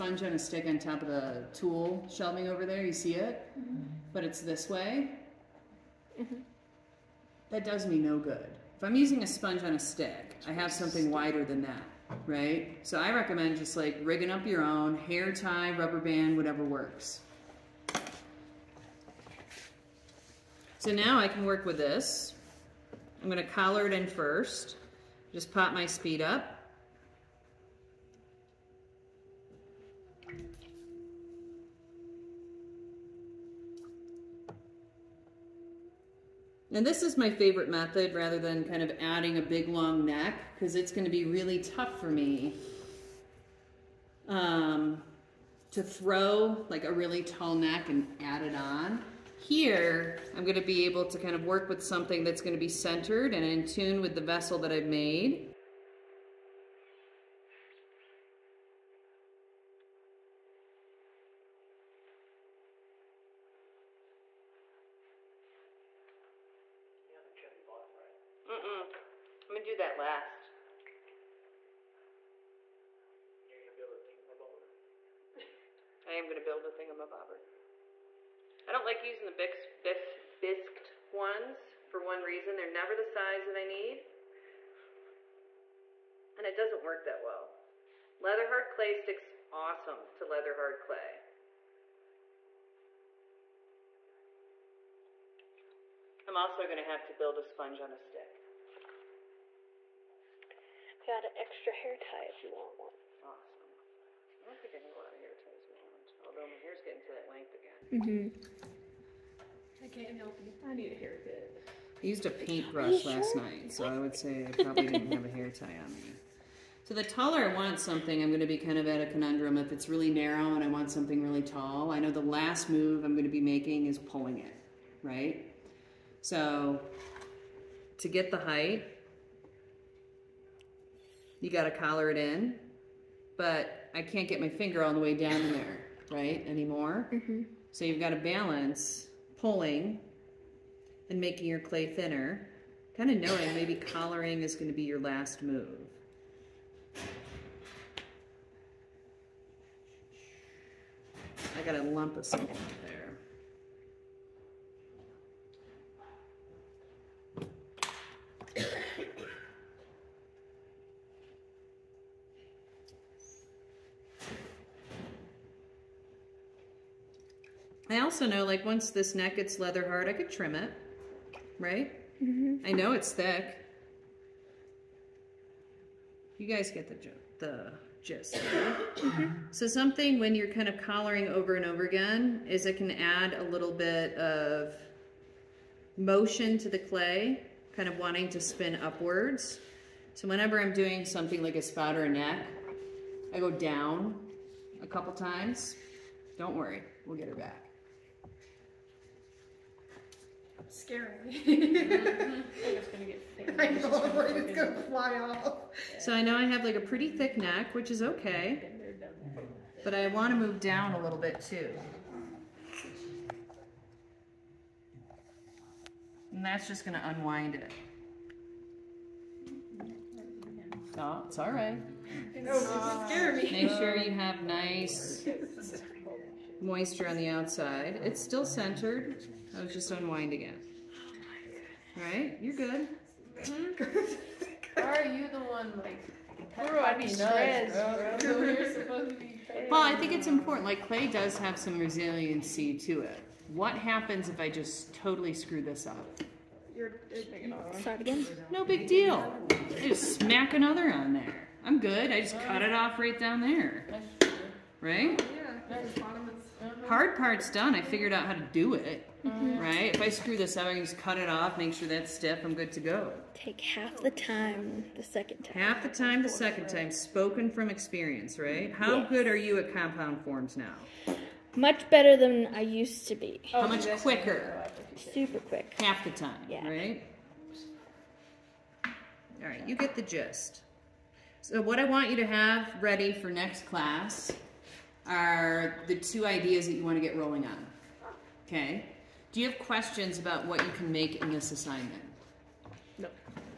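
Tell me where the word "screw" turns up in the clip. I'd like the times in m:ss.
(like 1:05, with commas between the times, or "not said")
4:05, 4:20.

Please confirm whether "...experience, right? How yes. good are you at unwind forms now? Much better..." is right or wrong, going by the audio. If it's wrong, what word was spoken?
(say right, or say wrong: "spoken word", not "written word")
wrong: "compound", not "unwind".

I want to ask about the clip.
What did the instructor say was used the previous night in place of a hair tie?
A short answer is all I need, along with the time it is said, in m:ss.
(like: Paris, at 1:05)
Paintbrush, at 1:52.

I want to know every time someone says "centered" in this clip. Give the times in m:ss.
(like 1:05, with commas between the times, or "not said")
0:52, 3:48.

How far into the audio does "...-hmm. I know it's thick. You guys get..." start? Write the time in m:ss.
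2:52.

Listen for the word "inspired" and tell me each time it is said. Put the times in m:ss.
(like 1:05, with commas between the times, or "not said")
not said.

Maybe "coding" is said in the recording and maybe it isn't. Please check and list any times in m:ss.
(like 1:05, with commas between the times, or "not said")
not said.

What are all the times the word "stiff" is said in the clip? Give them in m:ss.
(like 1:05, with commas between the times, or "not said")
4:22.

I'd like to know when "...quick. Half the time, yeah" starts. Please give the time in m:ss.
4:35.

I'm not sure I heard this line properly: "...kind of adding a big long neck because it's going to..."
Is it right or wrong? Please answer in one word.
right.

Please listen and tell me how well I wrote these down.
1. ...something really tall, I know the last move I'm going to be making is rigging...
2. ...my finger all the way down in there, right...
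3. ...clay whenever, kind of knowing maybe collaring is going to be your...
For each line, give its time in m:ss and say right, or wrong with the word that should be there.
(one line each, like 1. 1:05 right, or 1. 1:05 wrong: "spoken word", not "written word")
1. 2:00 wrong: "pulling", not "rigging"
2. 2:14 right
3. 2:21 wrong: "thinner", not "whenever".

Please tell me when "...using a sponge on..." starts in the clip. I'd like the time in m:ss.
0:09.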